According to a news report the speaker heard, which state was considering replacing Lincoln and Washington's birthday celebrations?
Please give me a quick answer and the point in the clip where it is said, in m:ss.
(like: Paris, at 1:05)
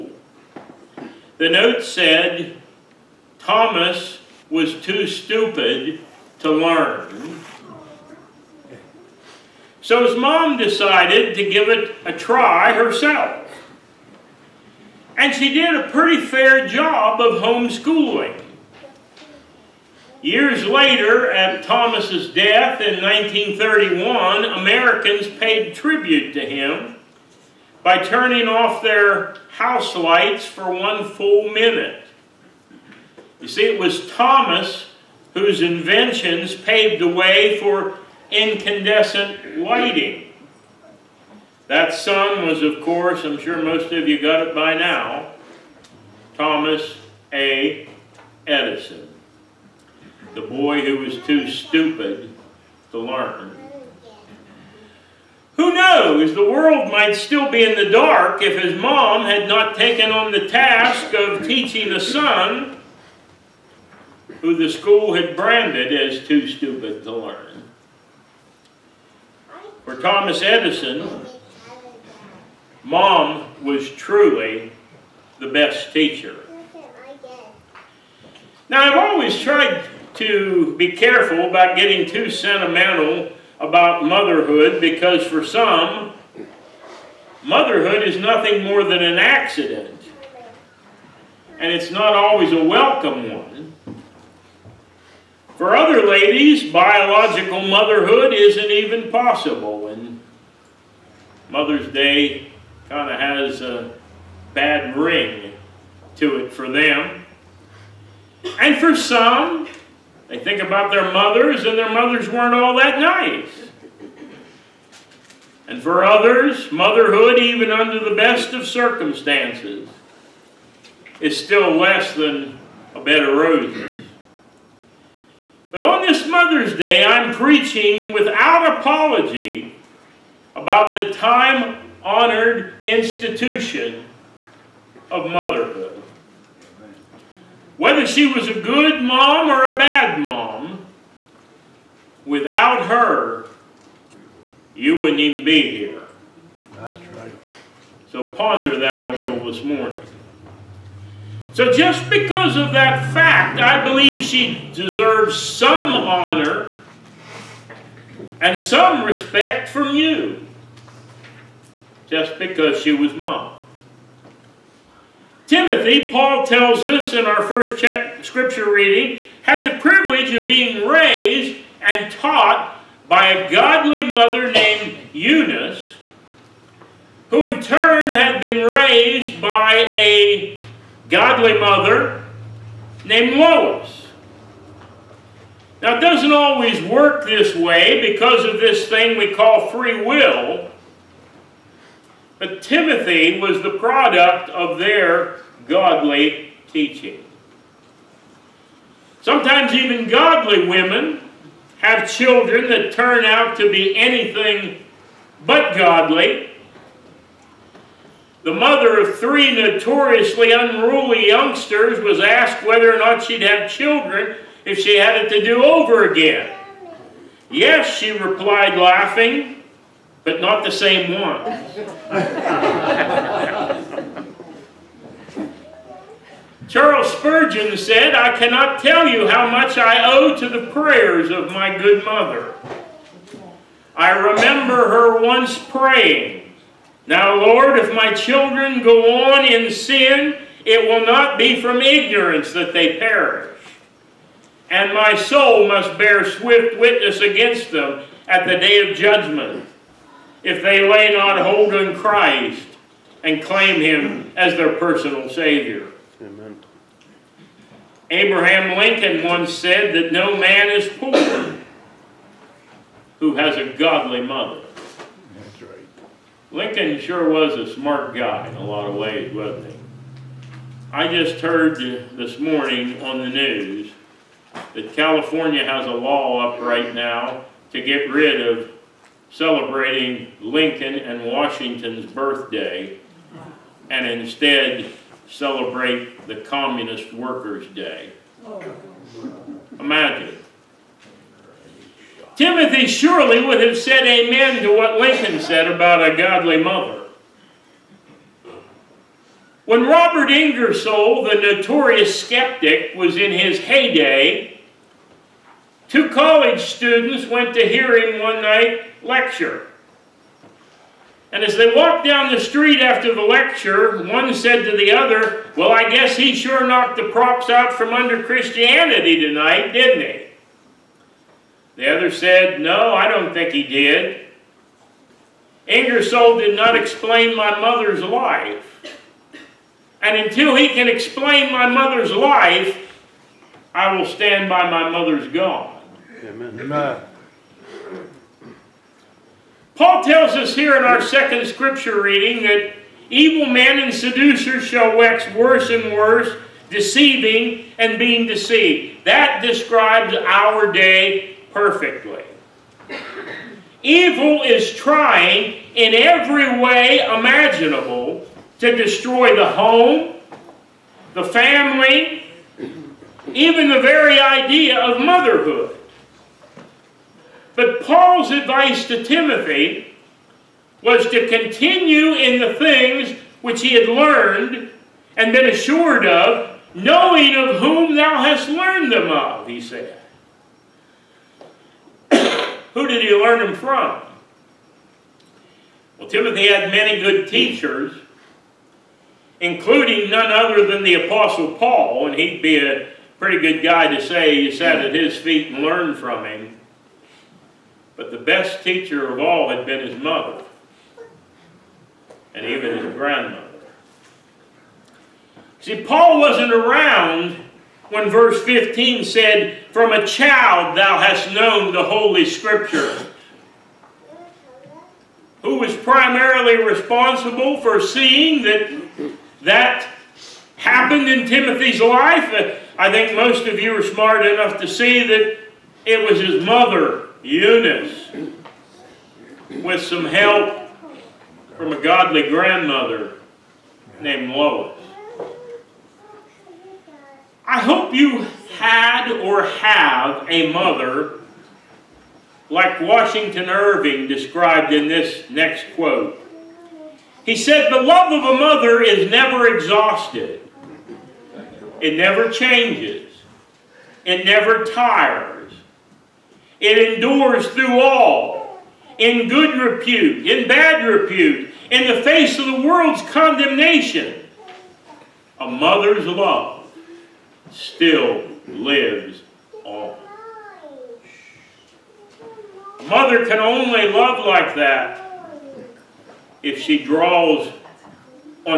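California, at 4:34.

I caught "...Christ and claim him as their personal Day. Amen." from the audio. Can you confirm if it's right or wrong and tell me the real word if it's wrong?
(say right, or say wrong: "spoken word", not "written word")
wrong: "Savior", not "Day".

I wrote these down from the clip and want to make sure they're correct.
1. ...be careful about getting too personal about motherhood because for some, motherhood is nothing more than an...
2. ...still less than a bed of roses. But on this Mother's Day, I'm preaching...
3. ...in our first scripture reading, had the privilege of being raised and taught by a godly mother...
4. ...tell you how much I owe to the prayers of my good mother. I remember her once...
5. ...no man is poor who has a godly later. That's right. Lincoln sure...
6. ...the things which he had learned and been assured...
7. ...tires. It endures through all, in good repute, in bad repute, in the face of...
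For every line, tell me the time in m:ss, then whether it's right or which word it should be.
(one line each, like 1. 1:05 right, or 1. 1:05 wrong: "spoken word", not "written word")
1. 1:20 wrong: "sentimental", not "personal"
2. 2:01 right
3. 2:47 right
4. 3:48 right
5. 4:20 wrong: "mother", not "later"
6. 6:12 right
7. 7:34 right.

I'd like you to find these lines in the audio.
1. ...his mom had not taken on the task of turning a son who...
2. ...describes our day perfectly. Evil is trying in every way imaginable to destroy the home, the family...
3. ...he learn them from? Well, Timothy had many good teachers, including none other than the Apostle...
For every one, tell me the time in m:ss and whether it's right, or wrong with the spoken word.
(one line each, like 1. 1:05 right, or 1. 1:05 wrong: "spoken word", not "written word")
1. 0:58 wrong: "teaching", not "turning"
2. 5:49 right
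3. 6:23 right.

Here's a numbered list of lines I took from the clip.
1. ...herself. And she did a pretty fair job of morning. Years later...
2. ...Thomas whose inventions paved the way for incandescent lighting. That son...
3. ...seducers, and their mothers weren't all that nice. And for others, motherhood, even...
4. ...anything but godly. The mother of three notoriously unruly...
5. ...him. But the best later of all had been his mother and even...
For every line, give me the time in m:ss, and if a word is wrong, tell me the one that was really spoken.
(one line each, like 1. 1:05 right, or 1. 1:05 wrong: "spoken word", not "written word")
1. 0:12 wrong: "homeschooling", not "morning"
2. 0:34 right
3. 1:51 wrong: "mothers", not "seducers"
4. 3:23 right
5. 6:36 wrong: "teacher", not "later".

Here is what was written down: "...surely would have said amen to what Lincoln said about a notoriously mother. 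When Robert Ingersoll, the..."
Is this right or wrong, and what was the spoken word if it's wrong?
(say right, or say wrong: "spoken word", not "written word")
wrong: "godly", not "notoriously".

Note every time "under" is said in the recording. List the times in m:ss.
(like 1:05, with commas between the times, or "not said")
1:57, 5:17.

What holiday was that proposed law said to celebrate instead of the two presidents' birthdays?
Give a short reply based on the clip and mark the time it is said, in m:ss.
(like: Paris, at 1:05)
Communist Workers' Day, at 4:46.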